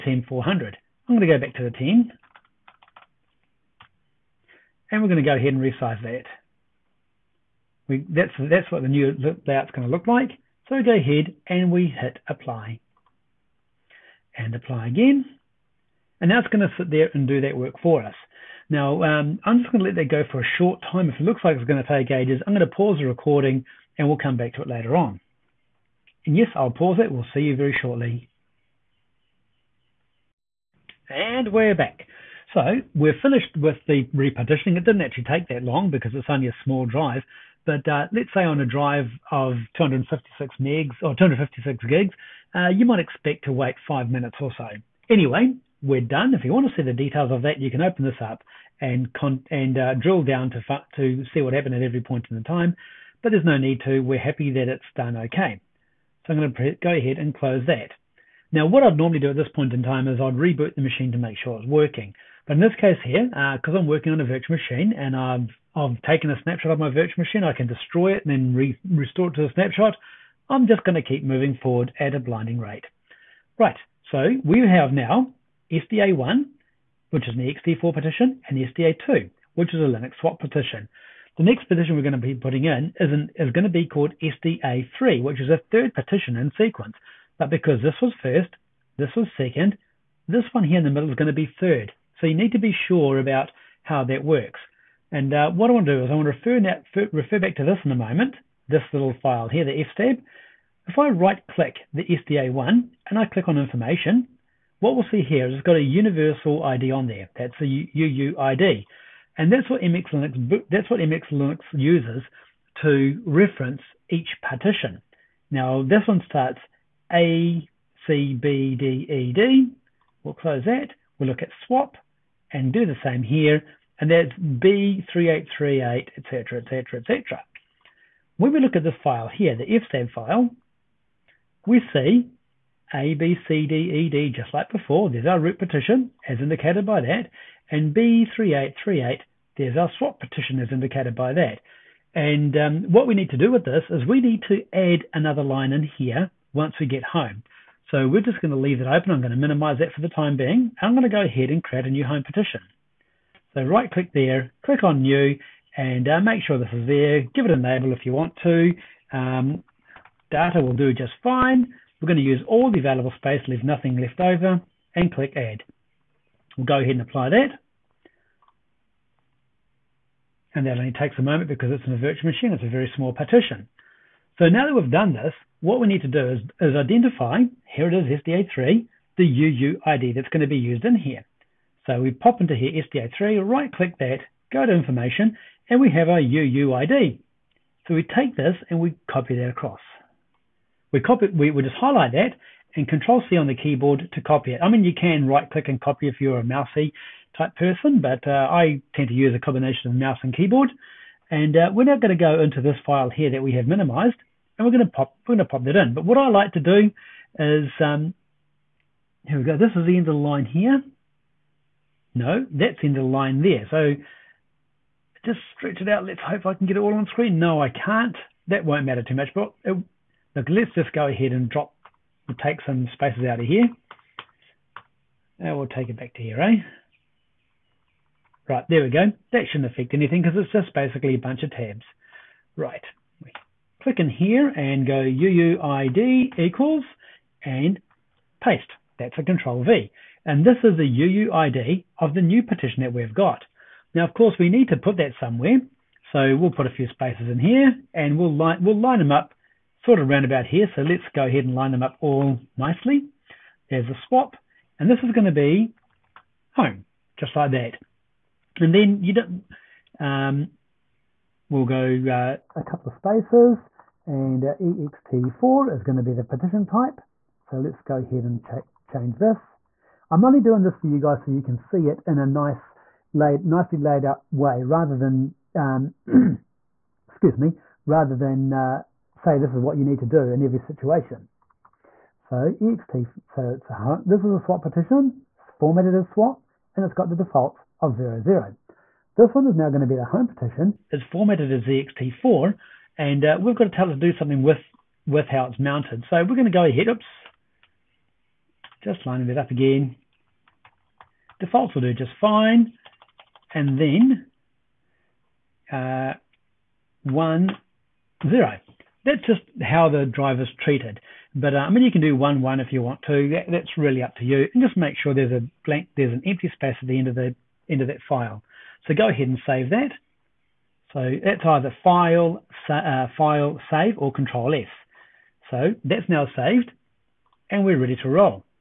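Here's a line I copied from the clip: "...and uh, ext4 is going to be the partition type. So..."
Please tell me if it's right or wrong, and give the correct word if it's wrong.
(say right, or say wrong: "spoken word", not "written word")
right.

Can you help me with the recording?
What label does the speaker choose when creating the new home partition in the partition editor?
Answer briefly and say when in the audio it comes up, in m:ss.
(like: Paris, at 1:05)
data, at 2:40.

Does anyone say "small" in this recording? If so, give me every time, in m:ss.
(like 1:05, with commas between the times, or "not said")
0:36, 2:52.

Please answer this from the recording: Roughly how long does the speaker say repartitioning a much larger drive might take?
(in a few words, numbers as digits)
5 minutes.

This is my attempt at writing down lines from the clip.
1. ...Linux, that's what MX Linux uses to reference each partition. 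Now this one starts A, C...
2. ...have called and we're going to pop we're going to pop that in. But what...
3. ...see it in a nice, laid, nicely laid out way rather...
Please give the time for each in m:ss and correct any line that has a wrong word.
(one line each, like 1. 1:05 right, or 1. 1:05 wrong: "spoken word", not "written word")
1. 1:50 right
2. 3:23 wrong: "minimized", not "called"
3. 4:31 right.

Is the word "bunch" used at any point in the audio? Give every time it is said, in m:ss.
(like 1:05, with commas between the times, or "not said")
3:51.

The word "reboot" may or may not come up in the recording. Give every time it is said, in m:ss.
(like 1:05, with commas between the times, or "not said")
1:00.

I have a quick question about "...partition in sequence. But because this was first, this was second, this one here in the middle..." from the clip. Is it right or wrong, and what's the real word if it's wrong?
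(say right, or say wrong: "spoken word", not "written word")
right.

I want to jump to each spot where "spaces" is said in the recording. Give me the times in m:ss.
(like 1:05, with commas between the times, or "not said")
2:43, 3:42, 4:06, 4:22, 5:16.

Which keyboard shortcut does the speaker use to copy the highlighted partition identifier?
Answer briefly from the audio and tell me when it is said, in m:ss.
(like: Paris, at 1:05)
Control C, at 3:12.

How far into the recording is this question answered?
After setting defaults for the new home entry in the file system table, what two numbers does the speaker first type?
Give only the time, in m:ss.
5:07.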